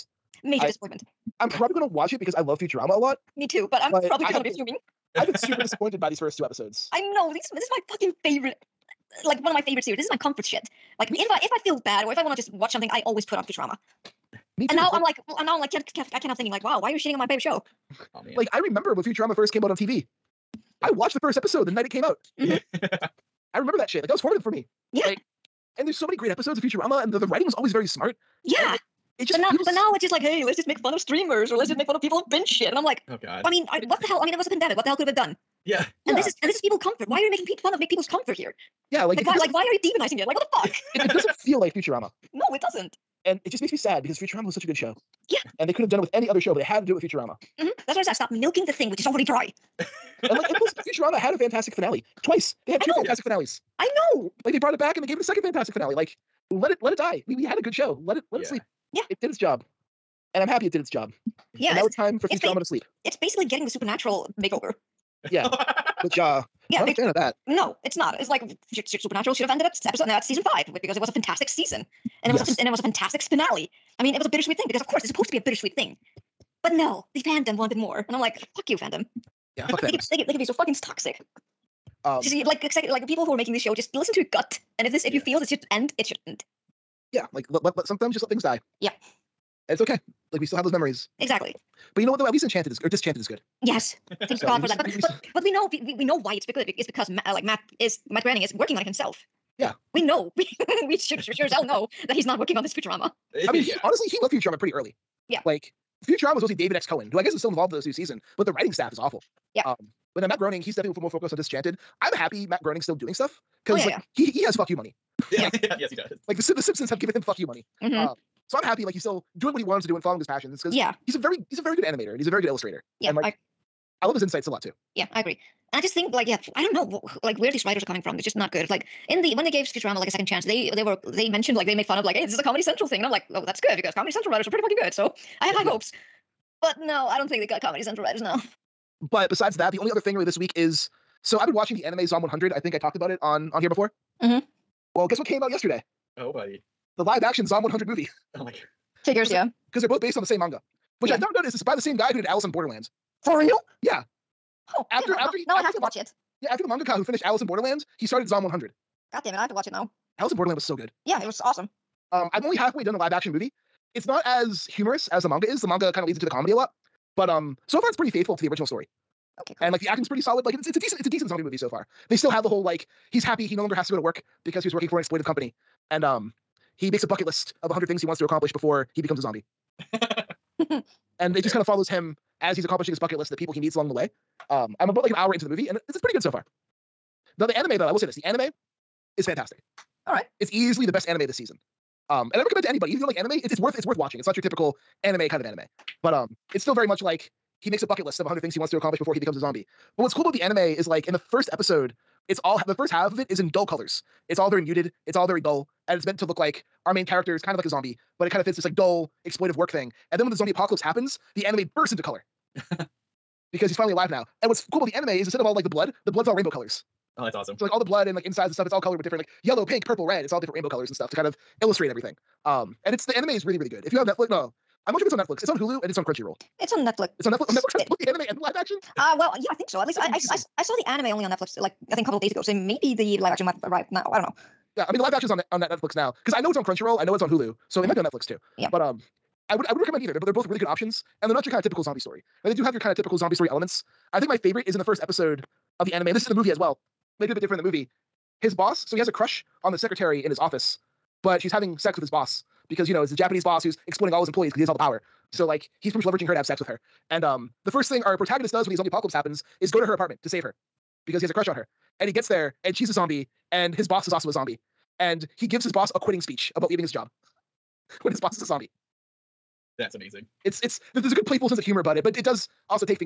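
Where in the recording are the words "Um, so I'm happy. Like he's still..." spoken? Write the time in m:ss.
1:58.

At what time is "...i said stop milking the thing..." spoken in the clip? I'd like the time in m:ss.
0:47.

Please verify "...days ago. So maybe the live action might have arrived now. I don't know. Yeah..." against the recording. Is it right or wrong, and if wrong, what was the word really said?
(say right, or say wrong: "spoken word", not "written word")
right.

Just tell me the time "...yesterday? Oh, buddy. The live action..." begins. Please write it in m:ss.
2:25.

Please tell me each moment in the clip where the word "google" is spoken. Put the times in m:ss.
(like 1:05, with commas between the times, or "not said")
not said.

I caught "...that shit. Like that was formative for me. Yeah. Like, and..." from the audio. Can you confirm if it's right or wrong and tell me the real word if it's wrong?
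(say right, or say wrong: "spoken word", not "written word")
right.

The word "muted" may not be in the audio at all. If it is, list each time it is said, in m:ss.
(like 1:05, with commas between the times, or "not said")
3:24.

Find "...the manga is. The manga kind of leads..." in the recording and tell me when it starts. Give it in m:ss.
2:45.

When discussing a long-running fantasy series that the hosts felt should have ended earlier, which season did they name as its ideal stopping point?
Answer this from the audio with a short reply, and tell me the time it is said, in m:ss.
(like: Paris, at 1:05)
season 5, at 1:10.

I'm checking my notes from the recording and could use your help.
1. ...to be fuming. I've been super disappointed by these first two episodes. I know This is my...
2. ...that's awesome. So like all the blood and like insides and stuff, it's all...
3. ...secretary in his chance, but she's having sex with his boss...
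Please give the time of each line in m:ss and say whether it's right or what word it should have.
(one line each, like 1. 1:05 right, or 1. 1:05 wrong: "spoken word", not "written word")
1. 0:04 right
2. 3:37 right
3. 4:09 wrong: "office", not "chance".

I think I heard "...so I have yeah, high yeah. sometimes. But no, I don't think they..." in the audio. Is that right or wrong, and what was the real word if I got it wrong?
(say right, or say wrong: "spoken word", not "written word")
wrong: "hopes", not "sometimes".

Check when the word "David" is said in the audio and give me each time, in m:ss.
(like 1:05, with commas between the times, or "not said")
1:46.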